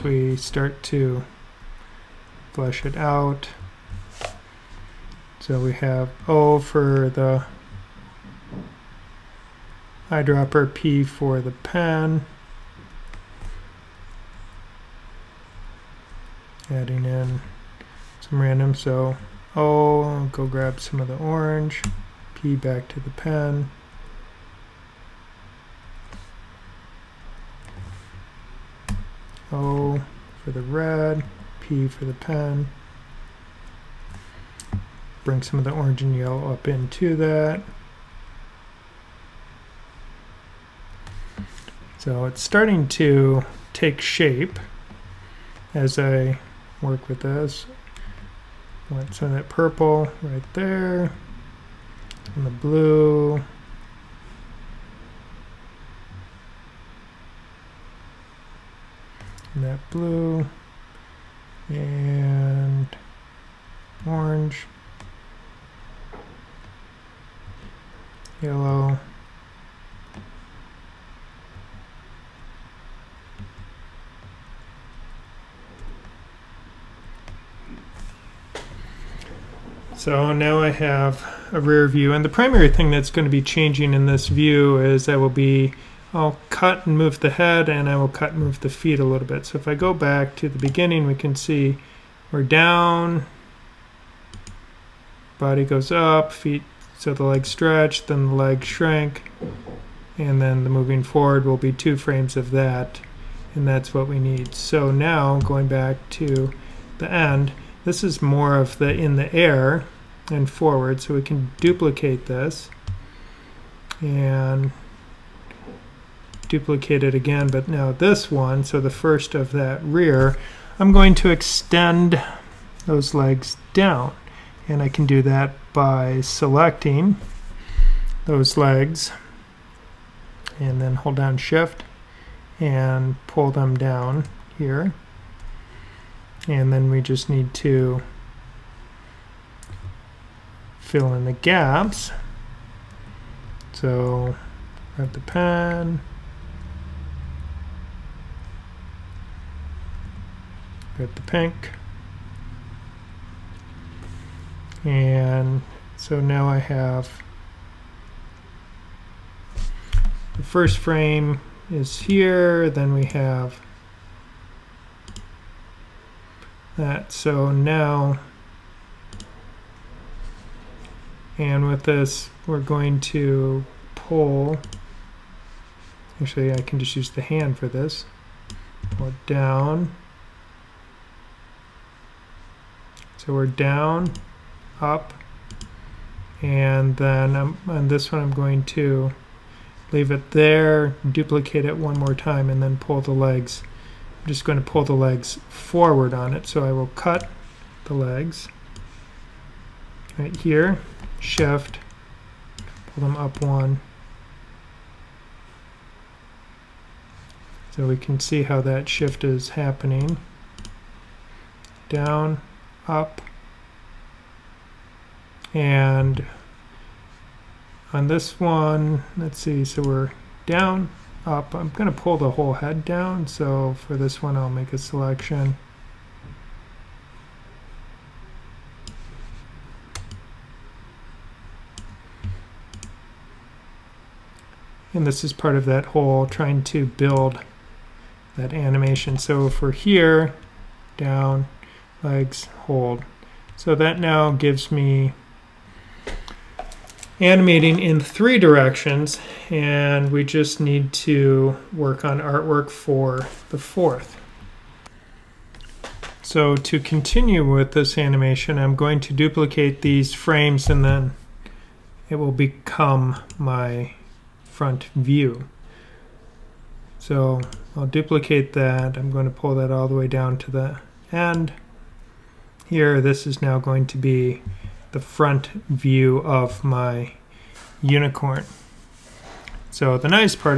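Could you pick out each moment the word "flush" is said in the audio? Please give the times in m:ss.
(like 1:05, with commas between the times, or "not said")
0:02.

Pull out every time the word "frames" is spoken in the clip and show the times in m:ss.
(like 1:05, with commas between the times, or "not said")
1:41, 2:40, 4:20.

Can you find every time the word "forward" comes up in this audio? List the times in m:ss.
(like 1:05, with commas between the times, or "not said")
1:41, 1:50, 3:15.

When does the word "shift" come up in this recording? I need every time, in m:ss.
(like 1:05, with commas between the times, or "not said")
2:11, 3:21, 3:28.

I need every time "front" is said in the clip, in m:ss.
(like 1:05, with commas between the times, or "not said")
4:24, 4:35.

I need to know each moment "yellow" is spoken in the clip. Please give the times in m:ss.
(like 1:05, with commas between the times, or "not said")
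0:36, 1:08.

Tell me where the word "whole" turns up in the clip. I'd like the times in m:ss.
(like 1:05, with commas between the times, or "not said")
3:42, 3:55.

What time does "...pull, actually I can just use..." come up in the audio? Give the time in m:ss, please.
2:53.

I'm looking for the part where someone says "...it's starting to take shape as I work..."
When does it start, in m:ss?
0:42.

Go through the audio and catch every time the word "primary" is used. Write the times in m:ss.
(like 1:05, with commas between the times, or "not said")
1:22.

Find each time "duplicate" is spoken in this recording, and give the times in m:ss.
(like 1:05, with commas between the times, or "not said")
1:51, 1:56, 3:11, 4:19, 4:27.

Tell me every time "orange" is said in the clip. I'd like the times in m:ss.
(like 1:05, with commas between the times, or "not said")
0:21, 0:35, 1:04.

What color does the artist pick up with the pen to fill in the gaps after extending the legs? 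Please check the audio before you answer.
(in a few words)
Pink.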